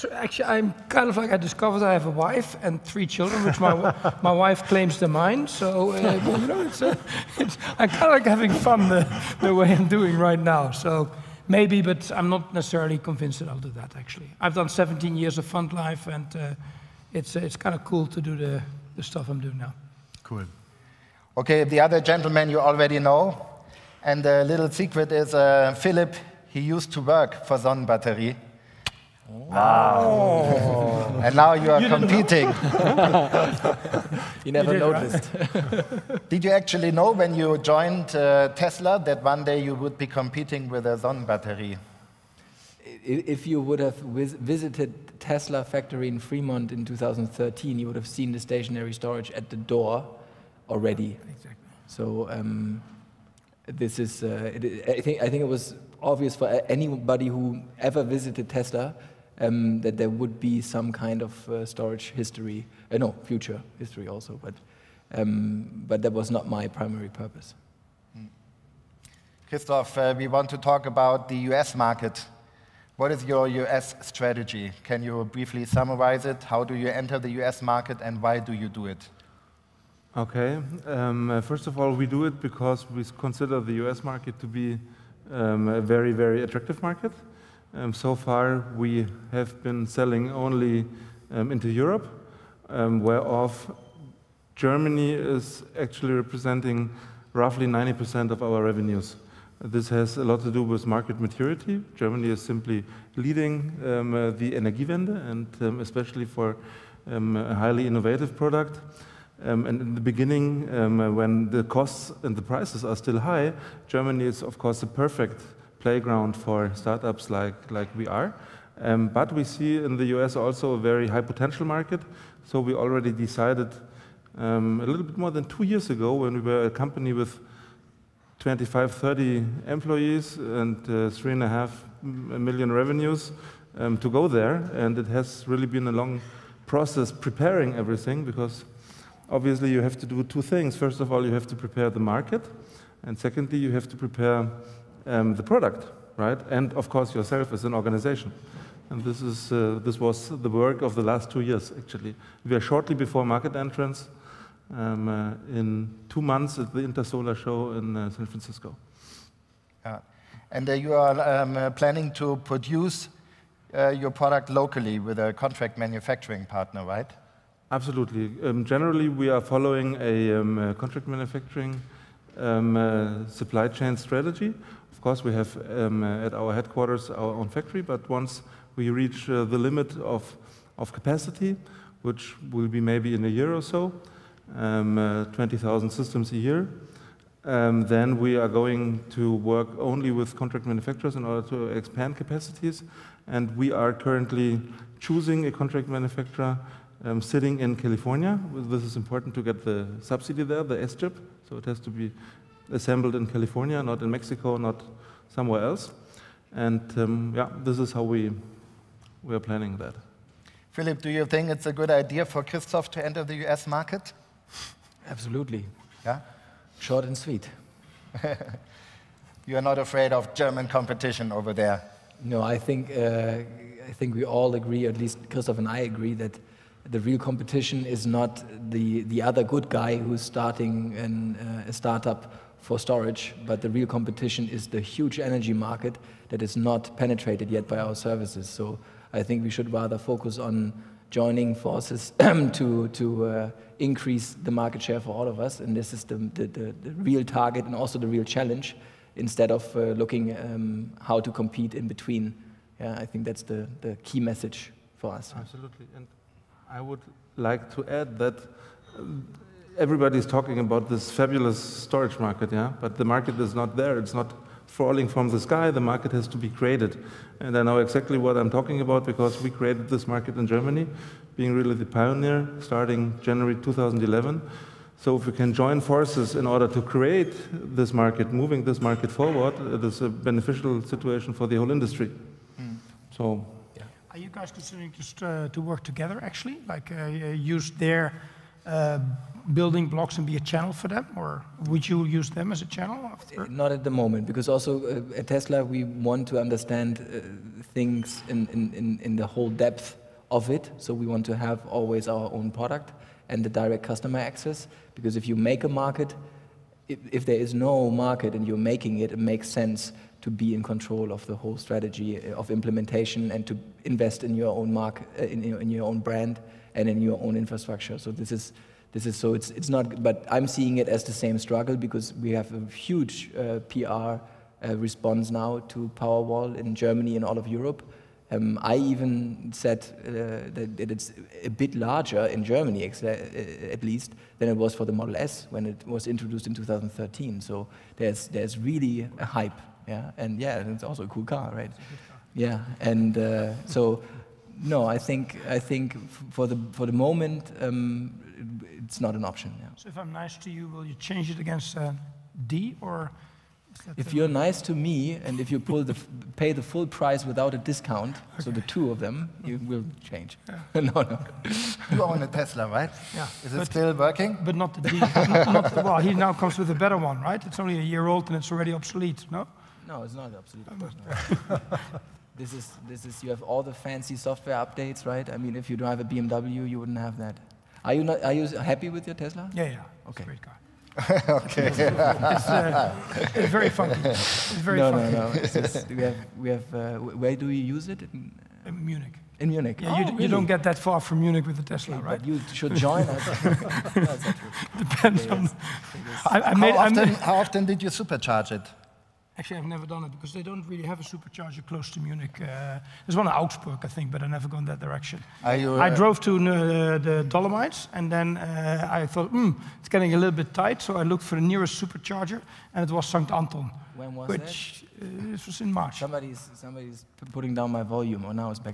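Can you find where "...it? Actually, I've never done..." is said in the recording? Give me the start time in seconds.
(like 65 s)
398 s.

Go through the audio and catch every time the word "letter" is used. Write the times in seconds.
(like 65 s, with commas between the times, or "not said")
not said.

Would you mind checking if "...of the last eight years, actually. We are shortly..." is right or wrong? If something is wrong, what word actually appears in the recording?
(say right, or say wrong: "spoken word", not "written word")
wrong: "two", not "eight".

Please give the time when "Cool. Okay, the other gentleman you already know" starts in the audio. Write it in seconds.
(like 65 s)
20 s.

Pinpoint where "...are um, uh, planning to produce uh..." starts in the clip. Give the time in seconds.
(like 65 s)
160 s.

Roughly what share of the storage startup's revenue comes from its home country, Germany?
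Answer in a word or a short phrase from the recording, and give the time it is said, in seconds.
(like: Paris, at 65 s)
90%, at 97 s.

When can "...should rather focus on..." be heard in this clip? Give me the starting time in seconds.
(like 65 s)
239 s.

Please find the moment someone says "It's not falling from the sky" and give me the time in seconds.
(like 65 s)
263 s.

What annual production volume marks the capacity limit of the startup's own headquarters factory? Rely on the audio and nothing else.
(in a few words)
20,000 systems.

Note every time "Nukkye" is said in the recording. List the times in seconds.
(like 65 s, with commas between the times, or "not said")
not said.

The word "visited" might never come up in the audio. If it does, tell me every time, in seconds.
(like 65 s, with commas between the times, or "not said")
43 s, 58 s.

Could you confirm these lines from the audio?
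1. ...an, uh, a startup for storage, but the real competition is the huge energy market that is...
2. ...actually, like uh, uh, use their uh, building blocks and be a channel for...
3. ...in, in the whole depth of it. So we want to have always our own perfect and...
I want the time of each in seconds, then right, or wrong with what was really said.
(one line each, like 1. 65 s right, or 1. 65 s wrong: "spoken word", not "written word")
1. 230 s right
2. 286 s right
3. 298 s wrong: "product", not "perfect".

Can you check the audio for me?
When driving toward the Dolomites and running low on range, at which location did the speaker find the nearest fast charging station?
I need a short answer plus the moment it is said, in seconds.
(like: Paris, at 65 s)
St. Anton, at 413 s.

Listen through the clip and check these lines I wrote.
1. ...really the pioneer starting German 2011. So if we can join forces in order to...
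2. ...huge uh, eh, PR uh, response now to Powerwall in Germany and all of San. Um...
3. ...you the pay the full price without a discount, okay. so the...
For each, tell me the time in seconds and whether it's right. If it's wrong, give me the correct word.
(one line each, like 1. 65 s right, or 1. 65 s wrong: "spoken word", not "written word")
1. 271 s wrong: "January", not "German"
2. 322 s wrong: "Europe", not "San"
3. 355 s right.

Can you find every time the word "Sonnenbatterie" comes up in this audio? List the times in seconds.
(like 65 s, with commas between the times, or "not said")
27 s, 40 s.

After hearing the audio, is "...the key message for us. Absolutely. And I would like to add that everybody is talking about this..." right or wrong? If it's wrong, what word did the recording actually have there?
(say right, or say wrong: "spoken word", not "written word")
right.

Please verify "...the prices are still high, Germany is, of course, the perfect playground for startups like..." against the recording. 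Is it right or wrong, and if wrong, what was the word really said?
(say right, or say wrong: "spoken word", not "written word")
right.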